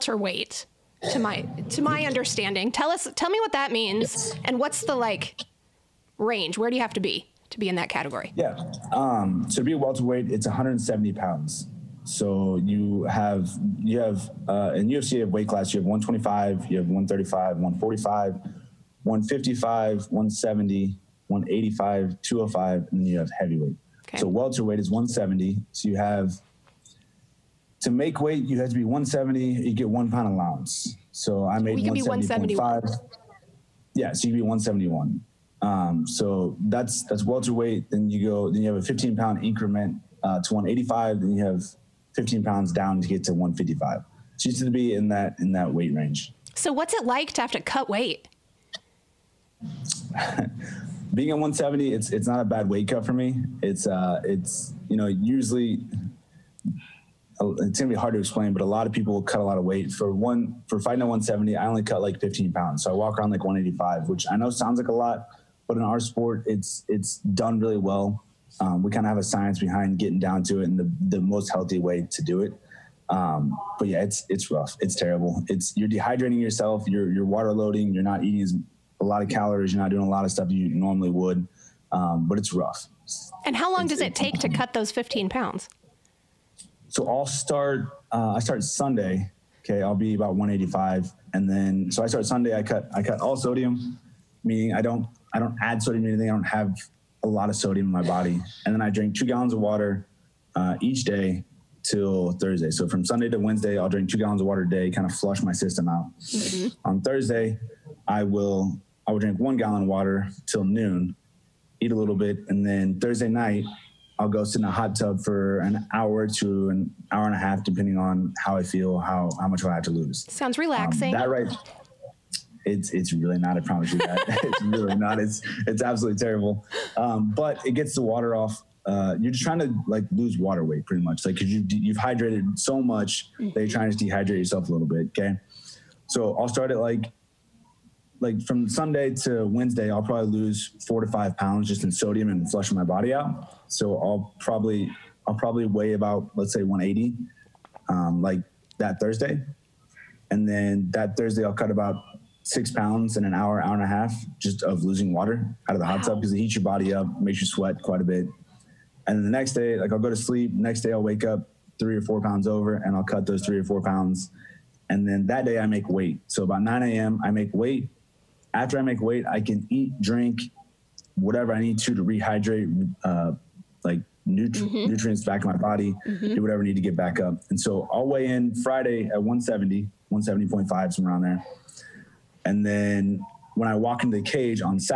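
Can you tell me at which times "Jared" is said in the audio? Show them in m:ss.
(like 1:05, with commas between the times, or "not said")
not said.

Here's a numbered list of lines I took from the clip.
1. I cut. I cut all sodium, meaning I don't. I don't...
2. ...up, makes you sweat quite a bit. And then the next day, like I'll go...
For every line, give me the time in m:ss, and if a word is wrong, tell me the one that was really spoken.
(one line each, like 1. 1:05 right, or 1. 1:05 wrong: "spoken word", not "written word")
1. 1:32 right
2. 2:36 right.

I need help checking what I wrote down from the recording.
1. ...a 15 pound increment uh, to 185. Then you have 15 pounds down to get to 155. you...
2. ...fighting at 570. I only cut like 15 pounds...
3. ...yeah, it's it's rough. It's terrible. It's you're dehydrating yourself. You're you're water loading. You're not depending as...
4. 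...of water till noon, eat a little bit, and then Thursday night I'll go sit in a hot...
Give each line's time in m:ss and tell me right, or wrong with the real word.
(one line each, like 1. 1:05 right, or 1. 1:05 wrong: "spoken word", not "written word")
1. 0:38 right
2. 1:00 wrong: "170", not "570"
3. 1:13 wrong: "eating", not "depending"
4. 1:49 right.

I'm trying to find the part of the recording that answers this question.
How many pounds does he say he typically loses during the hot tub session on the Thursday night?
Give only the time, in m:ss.
2:32.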